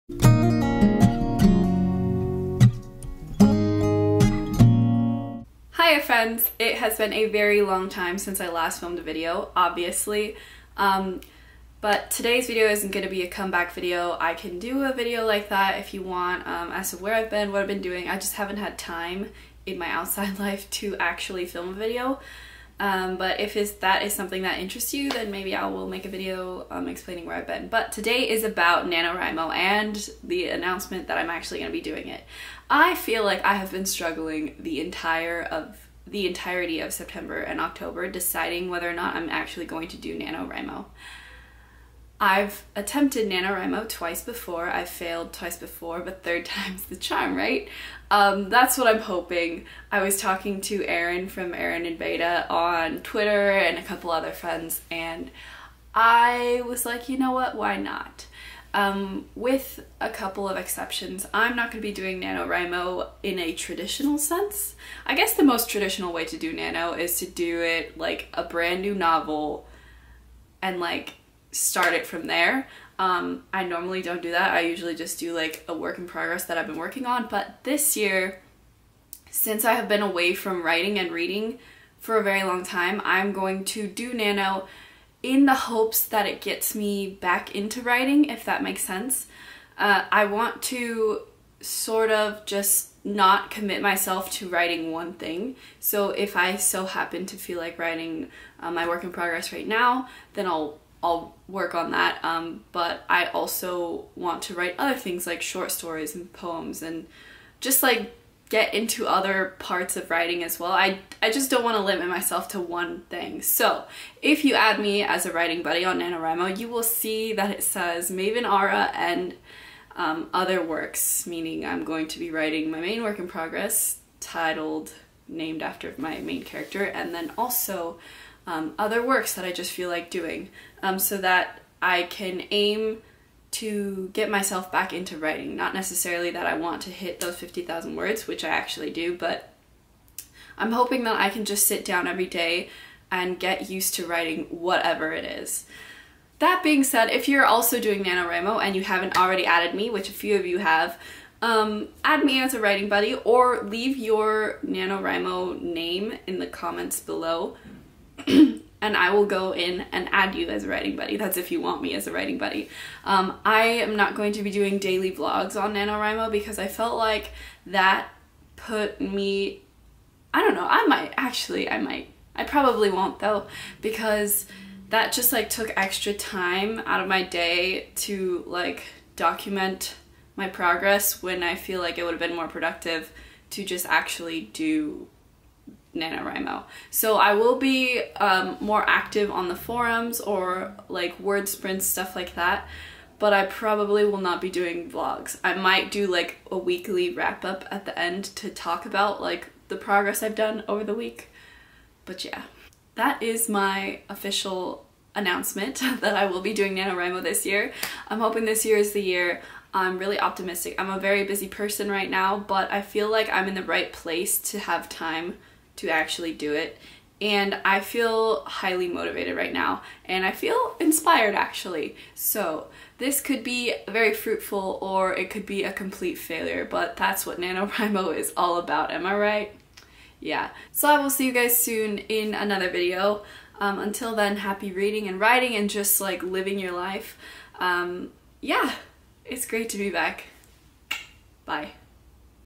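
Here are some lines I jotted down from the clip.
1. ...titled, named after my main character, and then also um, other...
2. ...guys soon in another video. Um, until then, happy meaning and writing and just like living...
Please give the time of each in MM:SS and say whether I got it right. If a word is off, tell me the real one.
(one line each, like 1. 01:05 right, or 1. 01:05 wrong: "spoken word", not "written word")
1. 02:04 right
2. 03:51 wrong: "reading", not "meaning".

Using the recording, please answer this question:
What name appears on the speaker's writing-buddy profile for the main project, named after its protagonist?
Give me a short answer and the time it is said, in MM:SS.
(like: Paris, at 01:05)
Maven Aura, at 01:58.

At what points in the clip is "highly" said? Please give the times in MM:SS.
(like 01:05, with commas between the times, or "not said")
03:38.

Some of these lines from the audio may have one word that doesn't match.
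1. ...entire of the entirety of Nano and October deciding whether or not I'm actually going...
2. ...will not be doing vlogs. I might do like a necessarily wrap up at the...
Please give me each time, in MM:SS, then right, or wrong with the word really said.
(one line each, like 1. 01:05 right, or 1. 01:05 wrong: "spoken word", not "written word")
1. 00:34 wrong: "September", not "Nano"
2. 03:14 wrong: "weekly", not "necessarily".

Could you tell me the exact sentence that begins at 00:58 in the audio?
Um, with a couple of exceptions, I'm not going to be doing NaNoWriMo in a traditional sense.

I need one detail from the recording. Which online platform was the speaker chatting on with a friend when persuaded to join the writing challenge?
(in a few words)
Twitter.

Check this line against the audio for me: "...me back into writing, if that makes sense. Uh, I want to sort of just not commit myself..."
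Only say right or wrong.
right.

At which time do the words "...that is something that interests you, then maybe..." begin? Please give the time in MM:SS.
00:23.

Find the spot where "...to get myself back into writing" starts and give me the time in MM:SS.
02:13.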